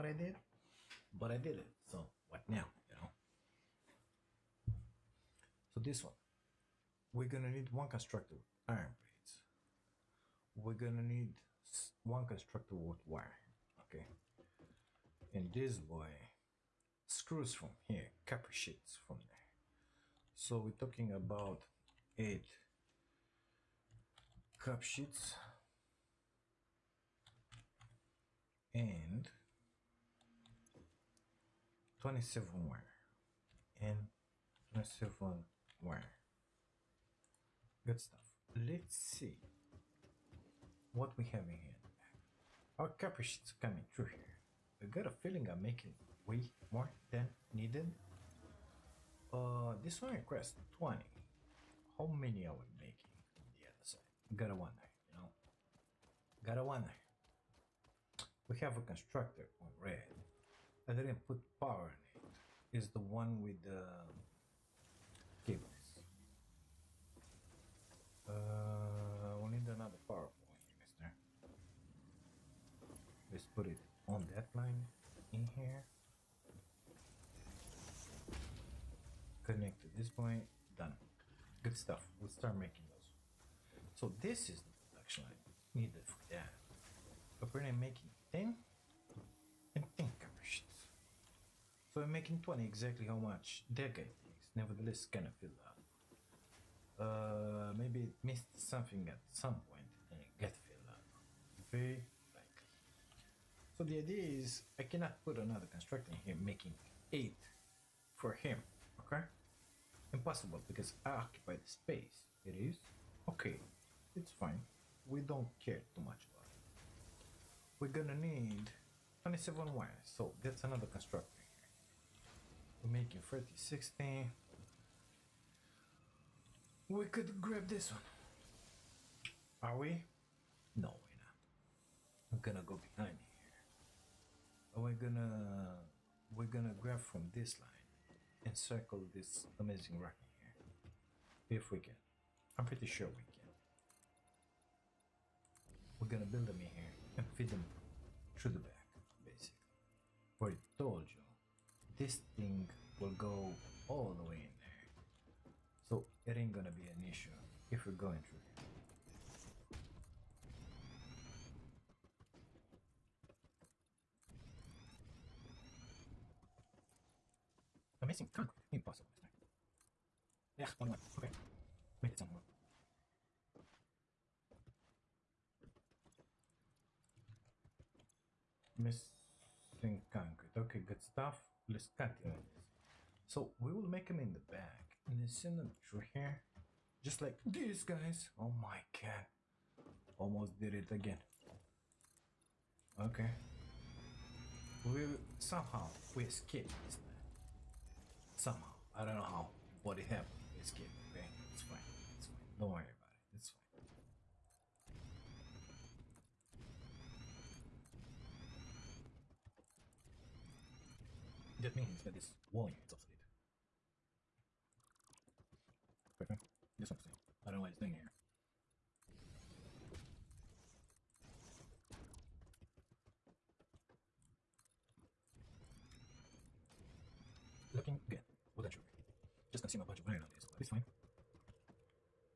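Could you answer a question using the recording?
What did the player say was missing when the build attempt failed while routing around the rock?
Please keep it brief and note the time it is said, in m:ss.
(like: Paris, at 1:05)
Concrete, at 2:58.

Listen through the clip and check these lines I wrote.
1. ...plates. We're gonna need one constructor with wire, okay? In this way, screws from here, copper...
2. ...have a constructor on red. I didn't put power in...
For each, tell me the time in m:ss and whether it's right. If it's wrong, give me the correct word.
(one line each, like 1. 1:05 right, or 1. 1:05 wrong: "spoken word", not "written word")
1. 0:08 right
2. 0:58 right.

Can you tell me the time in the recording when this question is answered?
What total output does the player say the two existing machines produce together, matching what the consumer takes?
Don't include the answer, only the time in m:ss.
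1:32.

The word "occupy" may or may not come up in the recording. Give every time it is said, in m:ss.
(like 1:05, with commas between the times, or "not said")
1:51.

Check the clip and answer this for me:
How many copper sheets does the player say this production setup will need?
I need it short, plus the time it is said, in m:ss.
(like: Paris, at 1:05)
8, at 0:22.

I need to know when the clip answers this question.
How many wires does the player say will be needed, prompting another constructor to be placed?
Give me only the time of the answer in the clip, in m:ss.
1:59.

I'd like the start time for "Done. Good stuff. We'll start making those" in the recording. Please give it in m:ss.
1:20.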